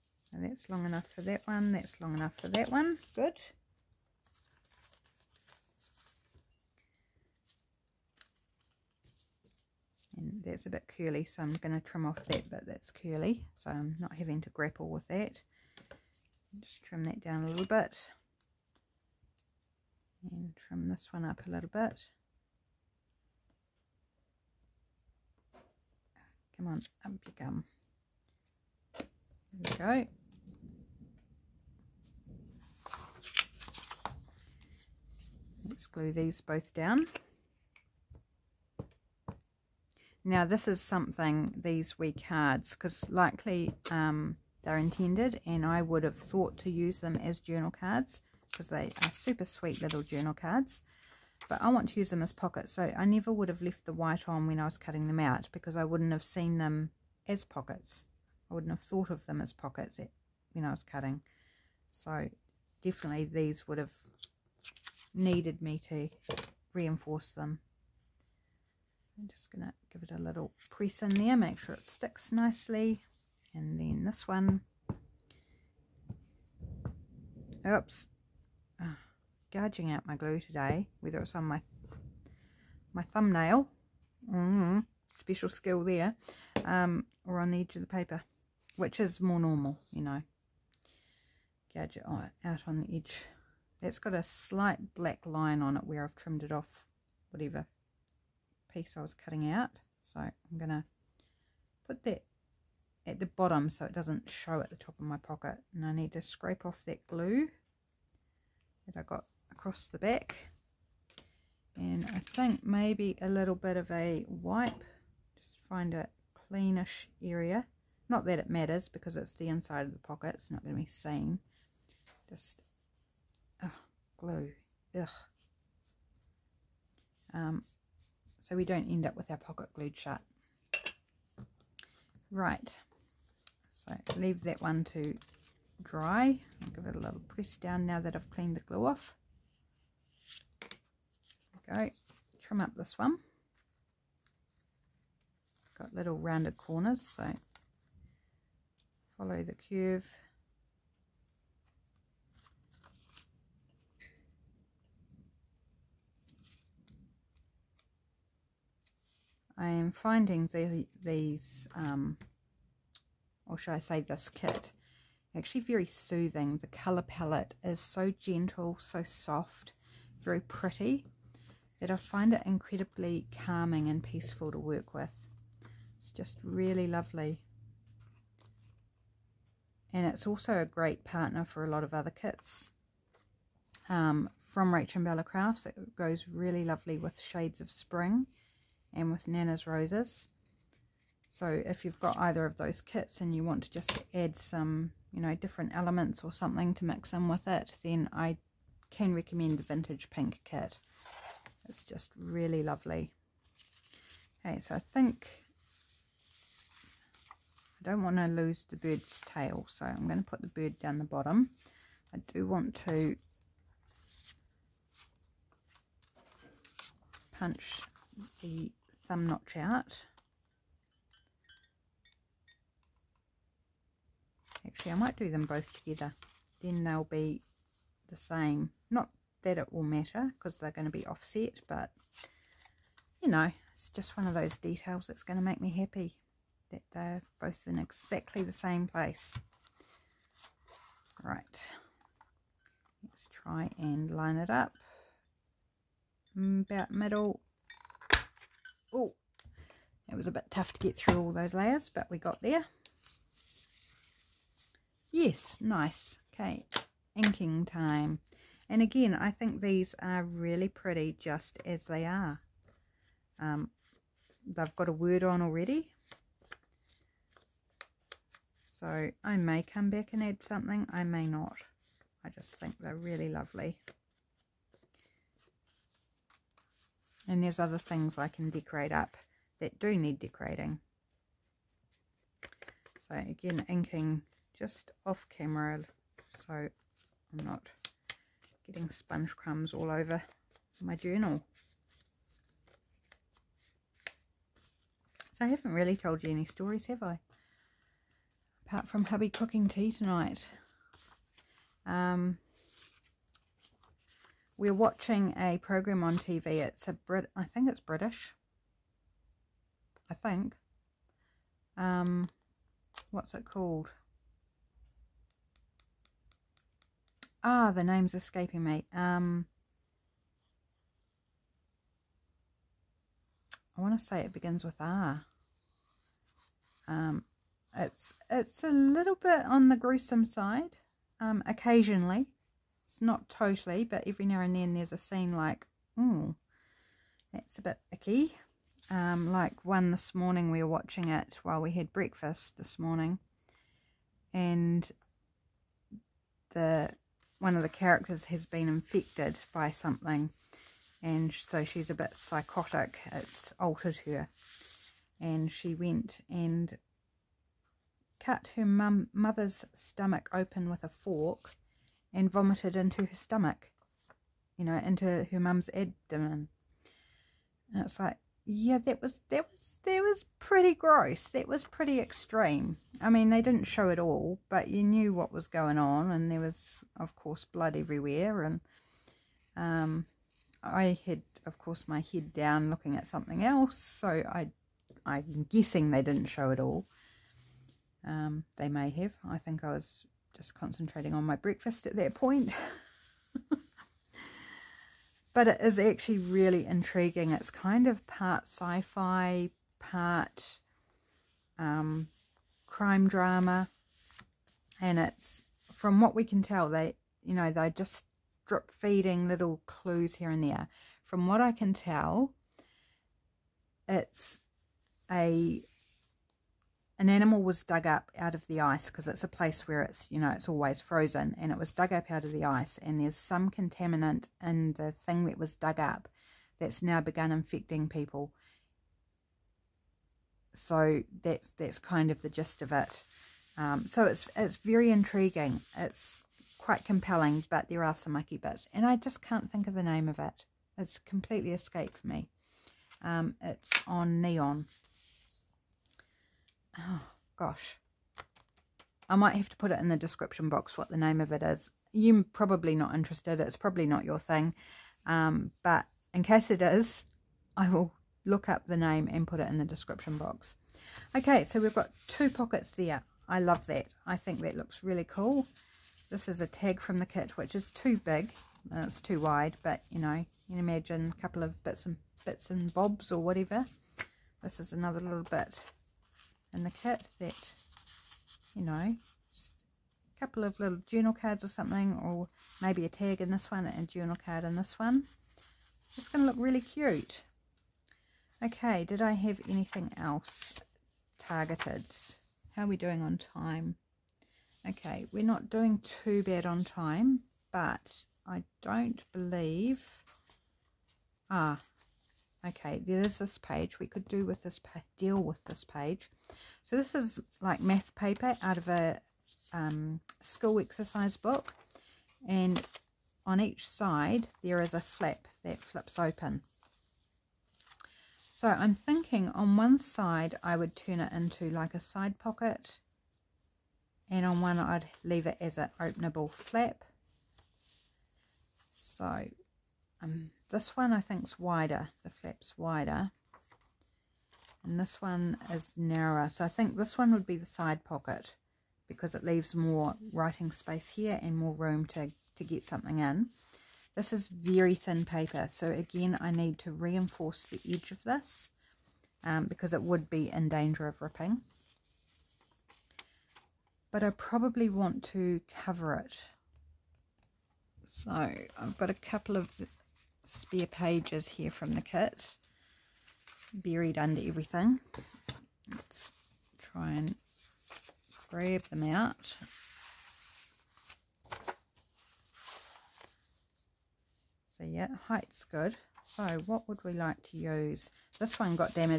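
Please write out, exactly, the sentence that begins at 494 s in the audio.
Okay, we're not doing too bad on time, but I don't believe...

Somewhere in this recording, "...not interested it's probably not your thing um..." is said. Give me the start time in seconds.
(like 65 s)
452 s.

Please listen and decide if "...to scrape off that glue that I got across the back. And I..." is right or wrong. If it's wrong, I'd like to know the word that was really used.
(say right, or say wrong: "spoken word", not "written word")
right.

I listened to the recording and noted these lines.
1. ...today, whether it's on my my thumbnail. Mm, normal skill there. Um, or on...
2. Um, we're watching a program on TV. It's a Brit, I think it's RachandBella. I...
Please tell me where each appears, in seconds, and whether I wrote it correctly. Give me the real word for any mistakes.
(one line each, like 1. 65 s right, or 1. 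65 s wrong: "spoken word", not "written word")
1. 80 s wrong: "special", not "normal"
2. 301 s wrong: "British", not "RachandBella".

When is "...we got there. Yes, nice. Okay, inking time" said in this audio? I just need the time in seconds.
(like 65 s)
252 s.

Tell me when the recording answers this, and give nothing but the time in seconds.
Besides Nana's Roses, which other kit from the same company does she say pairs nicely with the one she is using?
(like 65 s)
187 s.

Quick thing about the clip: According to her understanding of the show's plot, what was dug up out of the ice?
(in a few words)
An animal.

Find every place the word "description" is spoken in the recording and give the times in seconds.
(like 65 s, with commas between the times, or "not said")
449 s, 459 s.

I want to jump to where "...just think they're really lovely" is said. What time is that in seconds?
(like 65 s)
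272 s.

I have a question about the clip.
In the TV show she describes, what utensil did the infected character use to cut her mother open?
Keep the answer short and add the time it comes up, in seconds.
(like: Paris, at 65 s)
A fork, at 360 s.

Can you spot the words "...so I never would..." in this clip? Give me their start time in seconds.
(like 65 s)
52 s.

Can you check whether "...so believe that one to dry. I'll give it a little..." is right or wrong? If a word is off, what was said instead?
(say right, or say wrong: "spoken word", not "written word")
wrong: "leave", not "believe".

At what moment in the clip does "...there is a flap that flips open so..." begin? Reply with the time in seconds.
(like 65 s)
514 s.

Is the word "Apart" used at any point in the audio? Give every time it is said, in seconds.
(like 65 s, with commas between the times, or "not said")
298 s.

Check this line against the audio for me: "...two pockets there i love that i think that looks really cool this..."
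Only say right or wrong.
right.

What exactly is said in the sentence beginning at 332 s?
It's not totally, but every now and then there's a scene like, oh, that's a bit icky.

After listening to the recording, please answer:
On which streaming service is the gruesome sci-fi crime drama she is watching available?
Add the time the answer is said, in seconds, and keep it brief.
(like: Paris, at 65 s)
Neon, at 444 s.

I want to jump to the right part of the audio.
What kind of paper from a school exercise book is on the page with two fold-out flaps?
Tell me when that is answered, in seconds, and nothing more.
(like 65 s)
507 s.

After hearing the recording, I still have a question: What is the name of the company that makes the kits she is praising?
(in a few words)
RachandBella Crafts.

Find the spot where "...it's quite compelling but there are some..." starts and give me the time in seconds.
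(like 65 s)
435 s.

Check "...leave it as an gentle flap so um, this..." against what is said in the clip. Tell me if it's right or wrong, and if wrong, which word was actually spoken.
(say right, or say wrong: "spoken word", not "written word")
wrong: "openable", not "gentle".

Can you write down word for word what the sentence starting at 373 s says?
I mean, they didn't show it all, but you knew what was going on, and there was, of course, blood everywhere.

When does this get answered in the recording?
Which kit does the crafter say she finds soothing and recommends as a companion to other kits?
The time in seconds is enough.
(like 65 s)
199 s.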